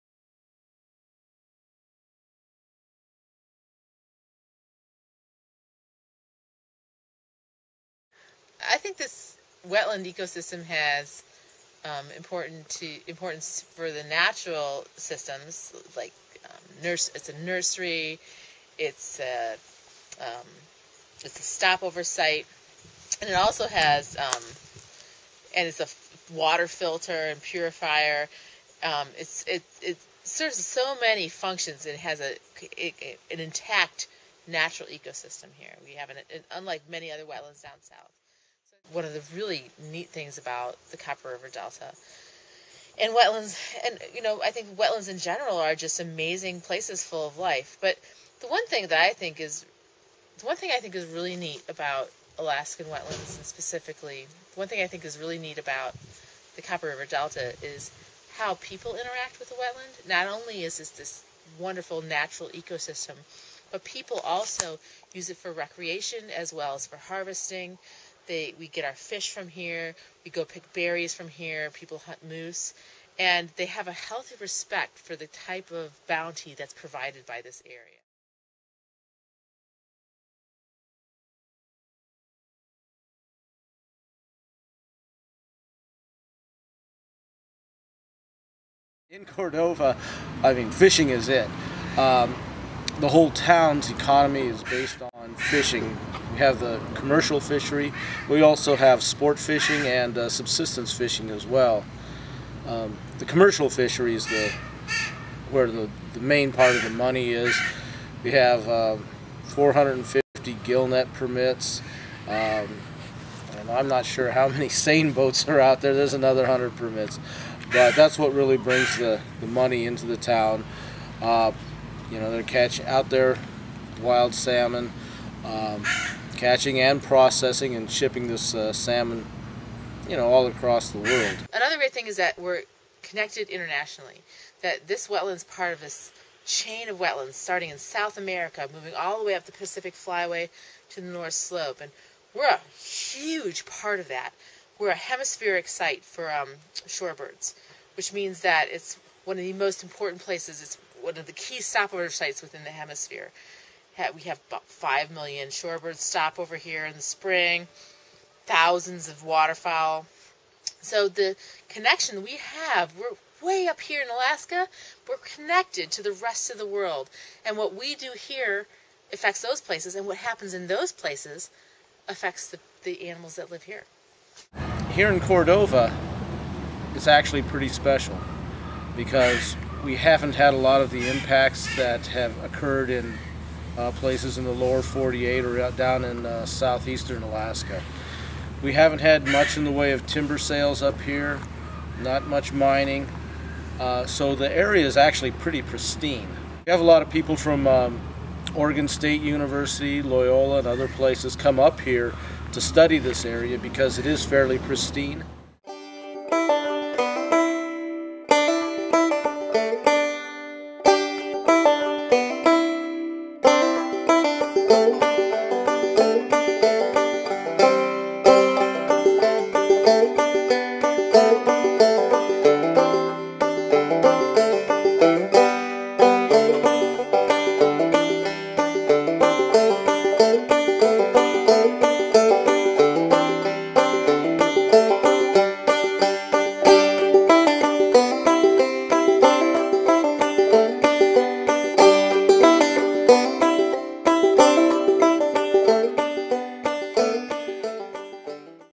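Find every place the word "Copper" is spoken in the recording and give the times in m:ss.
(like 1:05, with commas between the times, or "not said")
0:40, 0:56.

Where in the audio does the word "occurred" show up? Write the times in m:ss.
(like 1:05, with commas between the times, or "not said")
3:02.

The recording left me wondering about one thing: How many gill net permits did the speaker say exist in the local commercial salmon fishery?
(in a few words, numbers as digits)
450.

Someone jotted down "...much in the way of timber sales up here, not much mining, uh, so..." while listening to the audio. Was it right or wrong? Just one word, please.
right.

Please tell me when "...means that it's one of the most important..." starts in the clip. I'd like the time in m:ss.
2:28.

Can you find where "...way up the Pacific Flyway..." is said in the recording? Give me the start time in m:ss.
2:19.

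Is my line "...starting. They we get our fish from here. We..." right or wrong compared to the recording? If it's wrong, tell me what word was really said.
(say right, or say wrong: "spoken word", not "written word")
wrong: "harvesting", not "starting".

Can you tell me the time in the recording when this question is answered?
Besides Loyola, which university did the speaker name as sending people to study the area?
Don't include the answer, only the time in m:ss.
3:18.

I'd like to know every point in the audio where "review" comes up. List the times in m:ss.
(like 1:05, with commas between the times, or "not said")
not said.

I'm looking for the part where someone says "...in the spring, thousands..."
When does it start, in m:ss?
2:36.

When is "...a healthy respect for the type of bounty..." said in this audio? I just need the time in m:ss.
1:13.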